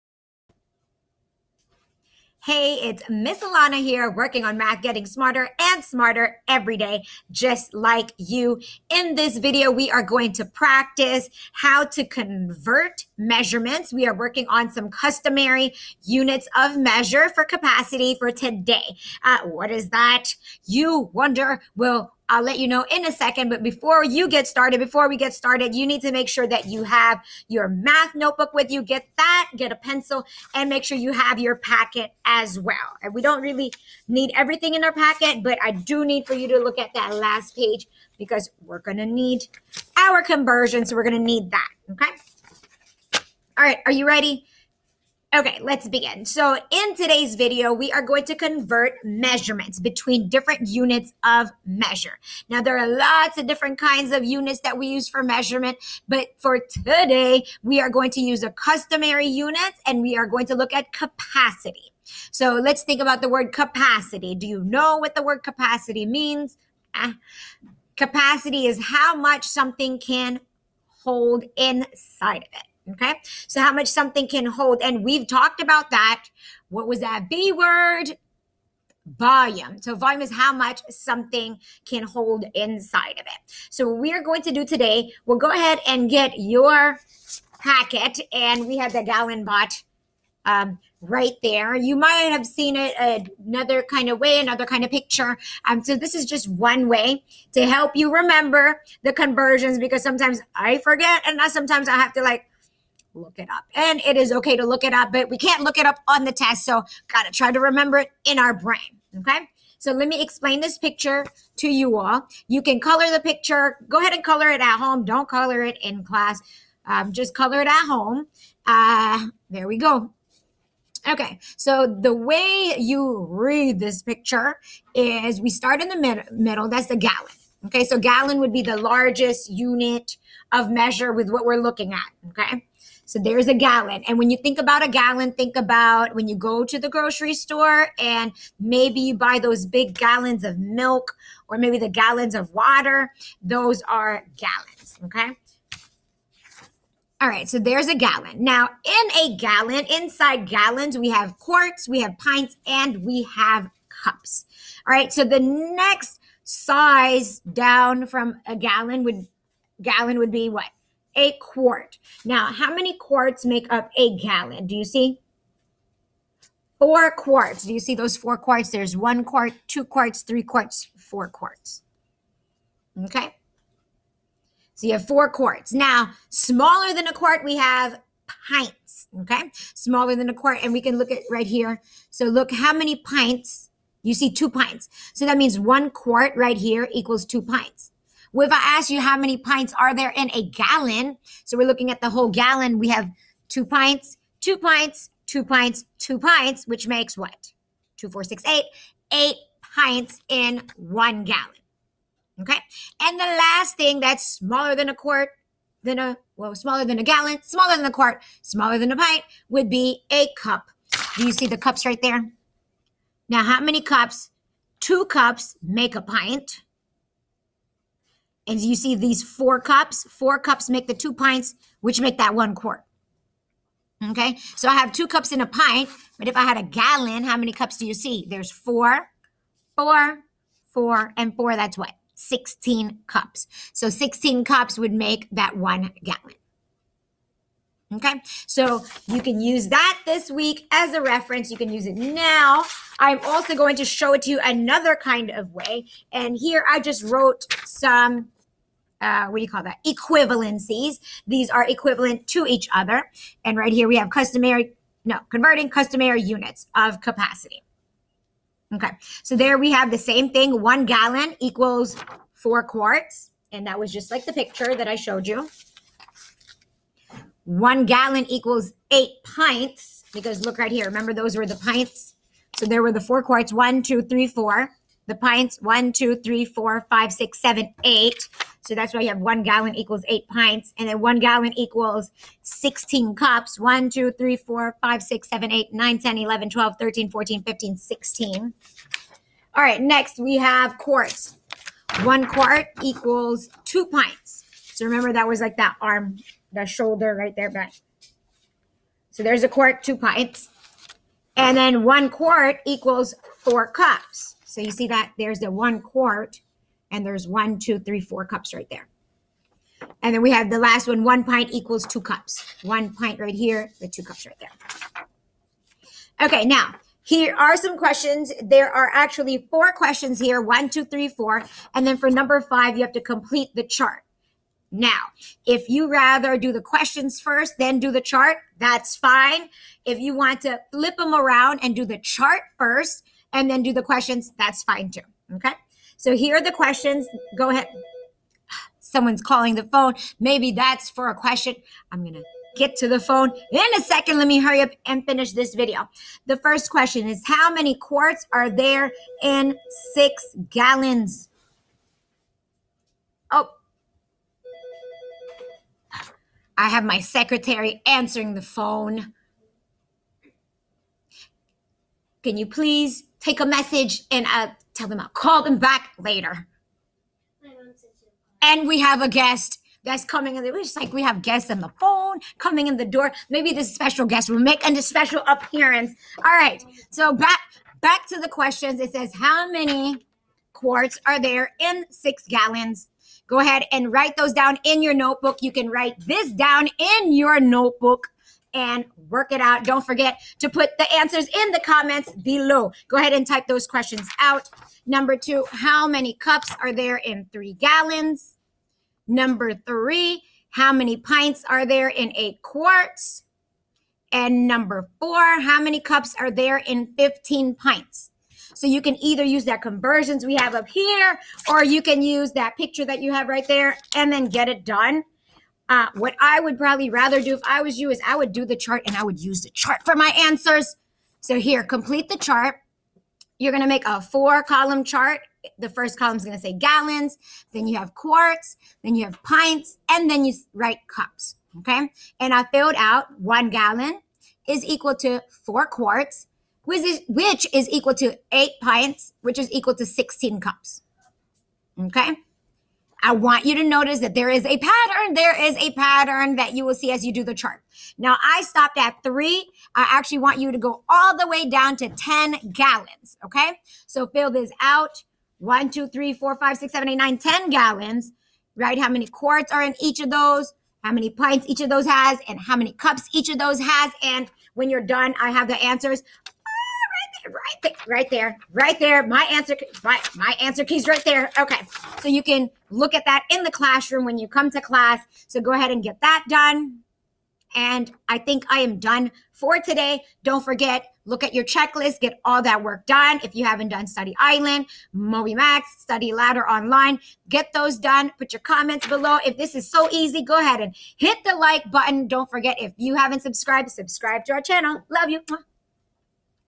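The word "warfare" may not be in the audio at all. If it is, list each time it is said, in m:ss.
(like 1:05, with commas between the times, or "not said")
not said.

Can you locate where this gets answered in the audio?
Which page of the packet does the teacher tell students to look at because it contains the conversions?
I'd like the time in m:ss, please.
0:37.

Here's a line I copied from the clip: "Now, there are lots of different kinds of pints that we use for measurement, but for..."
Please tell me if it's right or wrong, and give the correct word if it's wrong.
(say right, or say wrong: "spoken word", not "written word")
wrong: "units", not "pints".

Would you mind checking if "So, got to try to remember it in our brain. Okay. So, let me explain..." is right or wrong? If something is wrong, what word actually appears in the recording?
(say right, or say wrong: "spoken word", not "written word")
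right.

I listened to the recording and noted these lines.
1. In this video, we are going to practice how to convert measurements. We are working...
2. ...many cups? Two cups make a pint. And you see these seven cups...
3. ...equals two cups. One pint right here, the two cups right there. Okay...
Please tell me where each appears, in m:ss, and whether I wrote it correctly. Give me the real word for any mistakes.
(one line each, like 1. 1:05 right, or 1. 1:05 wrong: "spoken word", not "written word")
1. 0:08 right
2. 3:33 wrong: "four", not "seven"
3. 5:11 right.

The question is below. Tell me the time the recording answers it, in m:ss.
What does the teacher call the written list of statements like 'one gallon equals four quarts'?
4:09.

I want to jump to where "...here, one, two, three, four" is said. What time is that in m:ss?
5:20.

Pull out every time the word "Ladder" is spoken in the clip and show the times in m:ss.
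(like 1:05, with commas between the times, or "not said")
8:06.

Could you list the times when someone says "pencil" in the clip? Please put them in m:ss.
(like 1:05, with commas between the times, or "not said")
0:29.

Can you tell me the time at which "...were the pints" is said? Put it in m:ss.
4:31.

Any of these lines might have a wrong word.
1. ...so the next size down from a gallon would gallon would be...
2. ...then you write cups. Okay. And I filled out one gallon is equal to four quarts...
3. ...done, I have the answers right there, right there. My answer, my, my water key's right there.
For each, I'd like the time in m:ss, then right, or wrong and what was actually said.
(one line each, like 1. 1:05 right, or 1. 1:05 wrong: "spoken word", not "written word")
1. 2:35 right
2. 7:10 right
3. 7:44 wrong: "answer", not "water".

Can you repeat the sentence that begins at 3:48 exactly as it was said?
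There's four, four, four, and four.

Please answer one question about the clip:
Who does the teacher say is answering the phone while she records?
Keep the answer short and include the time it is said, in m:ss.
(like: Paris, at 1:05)
my secretary, at 5:56.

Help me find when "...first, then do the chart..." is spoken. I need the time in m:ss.
5:27.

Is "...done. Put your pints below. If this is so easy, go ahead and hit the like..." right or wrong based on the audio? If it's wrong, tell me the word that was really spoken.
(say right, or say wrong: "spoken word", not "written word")
wrong: "comments", not "pints".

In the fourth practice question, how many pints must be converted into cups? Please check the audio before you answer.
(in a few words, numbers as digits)
15.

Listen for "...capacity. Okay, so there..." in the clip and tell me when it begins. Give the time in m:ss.
4:17.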